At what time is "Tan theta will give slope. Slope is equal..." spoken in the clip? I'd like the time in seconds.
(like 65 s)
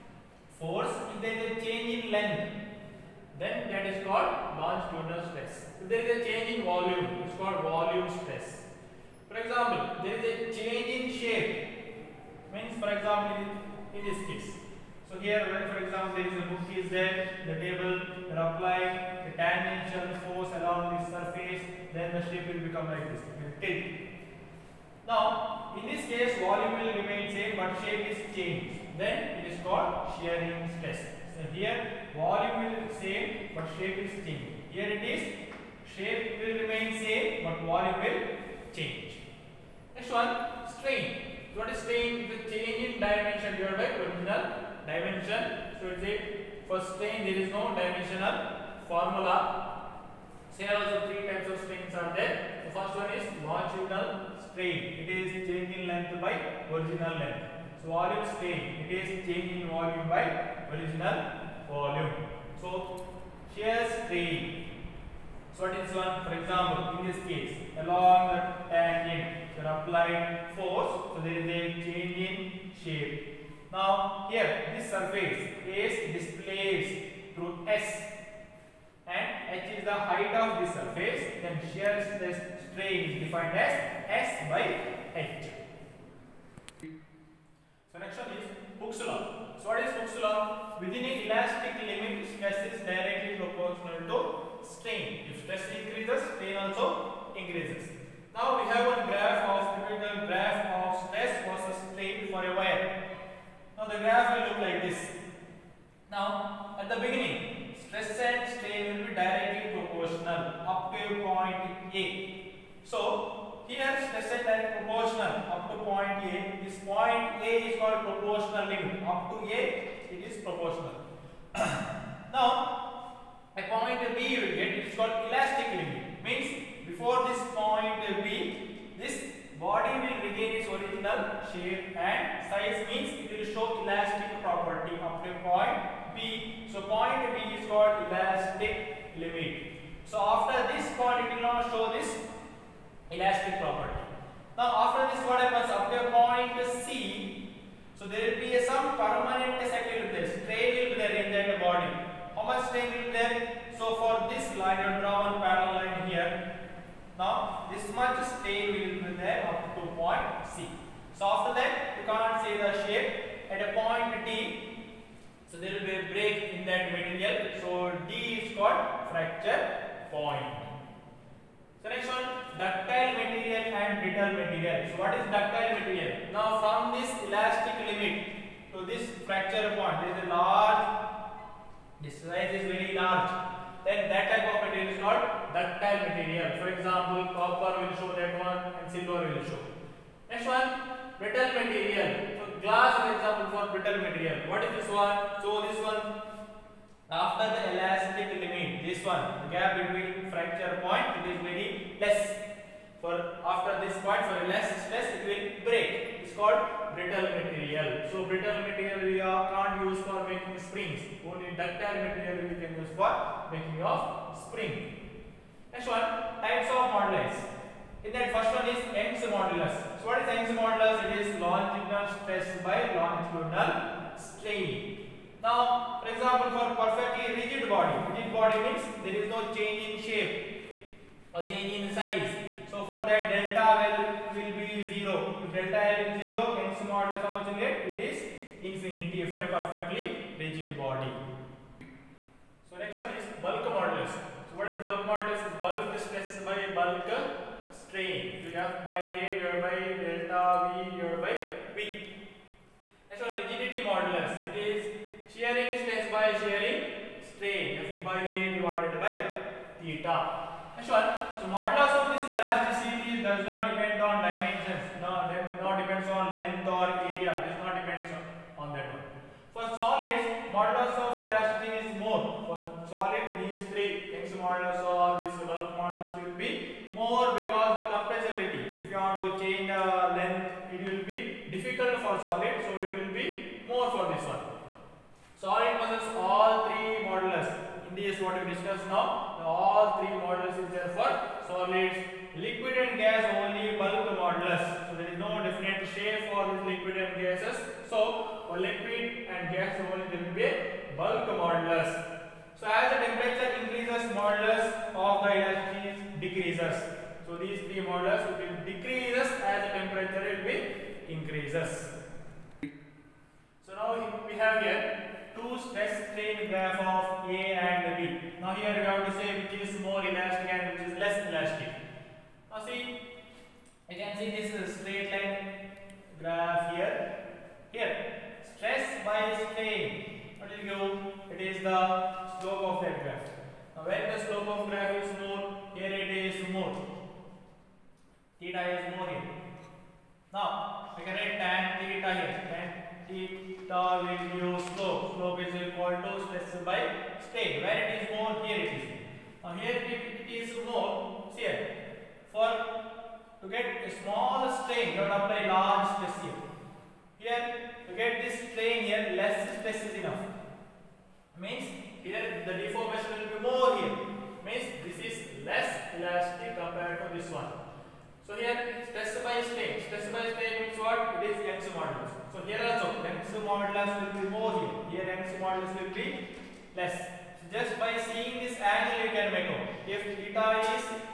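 342 s.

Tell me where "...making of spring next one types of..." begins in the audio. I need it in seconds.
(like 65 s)
213 s.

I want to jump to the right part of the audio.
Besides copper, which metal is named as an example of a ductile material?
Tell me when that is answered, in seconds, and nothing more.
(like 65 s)
188 s.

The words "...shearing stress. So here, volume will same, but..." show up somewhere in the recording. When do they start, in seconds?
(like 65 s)
30 s.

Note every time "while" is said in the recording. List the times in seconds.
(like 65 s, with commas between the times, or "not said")
not said.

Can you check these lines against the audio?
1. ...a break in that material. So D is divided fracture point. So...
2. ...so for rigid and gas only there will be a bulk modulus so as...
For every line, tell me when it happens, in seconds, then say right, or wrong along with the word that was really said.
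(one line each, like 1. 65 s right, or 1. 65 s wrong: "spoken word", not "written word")
1. 166 s wrong: "called", not "divided"
2. 297 s wrong: "liquid", not "rigid".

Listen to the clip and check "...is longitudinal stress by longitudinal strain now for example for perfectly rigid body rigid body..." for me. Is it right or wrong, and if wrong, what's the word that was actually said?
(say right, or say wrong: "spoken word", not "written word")
right.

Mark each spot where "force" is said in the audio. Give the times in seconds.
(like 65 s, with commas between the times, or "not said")
0 s, 20 s, 70 s.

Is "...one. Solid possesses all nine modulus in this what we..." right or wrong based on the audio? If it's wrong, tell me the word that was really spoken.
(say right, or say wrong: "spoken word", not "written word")
wrong: "three", not "nine".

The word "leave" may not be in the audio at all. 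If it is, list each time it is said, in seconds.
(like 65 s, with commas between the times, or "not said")
not said.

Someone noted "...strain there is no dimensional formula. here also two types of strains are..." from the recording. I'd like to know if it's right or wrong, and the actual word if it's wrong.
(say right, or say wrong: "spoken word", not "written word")
wrong: "three", not "two".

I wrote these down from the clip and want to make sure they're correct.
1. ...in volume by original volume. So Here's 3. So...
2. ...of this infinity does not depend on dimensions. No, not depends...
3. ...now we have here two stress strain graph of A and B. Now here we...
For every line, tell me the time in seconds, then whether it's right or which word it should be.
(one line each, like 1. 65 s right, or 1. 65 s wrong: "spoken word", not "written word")
1. 59 s right
2. 261 s wrong: "elasticity", not "infinity"
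3. 313 s right.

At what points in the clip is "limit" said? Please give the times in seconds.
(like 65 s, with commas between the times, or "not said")
177 s, 198 s.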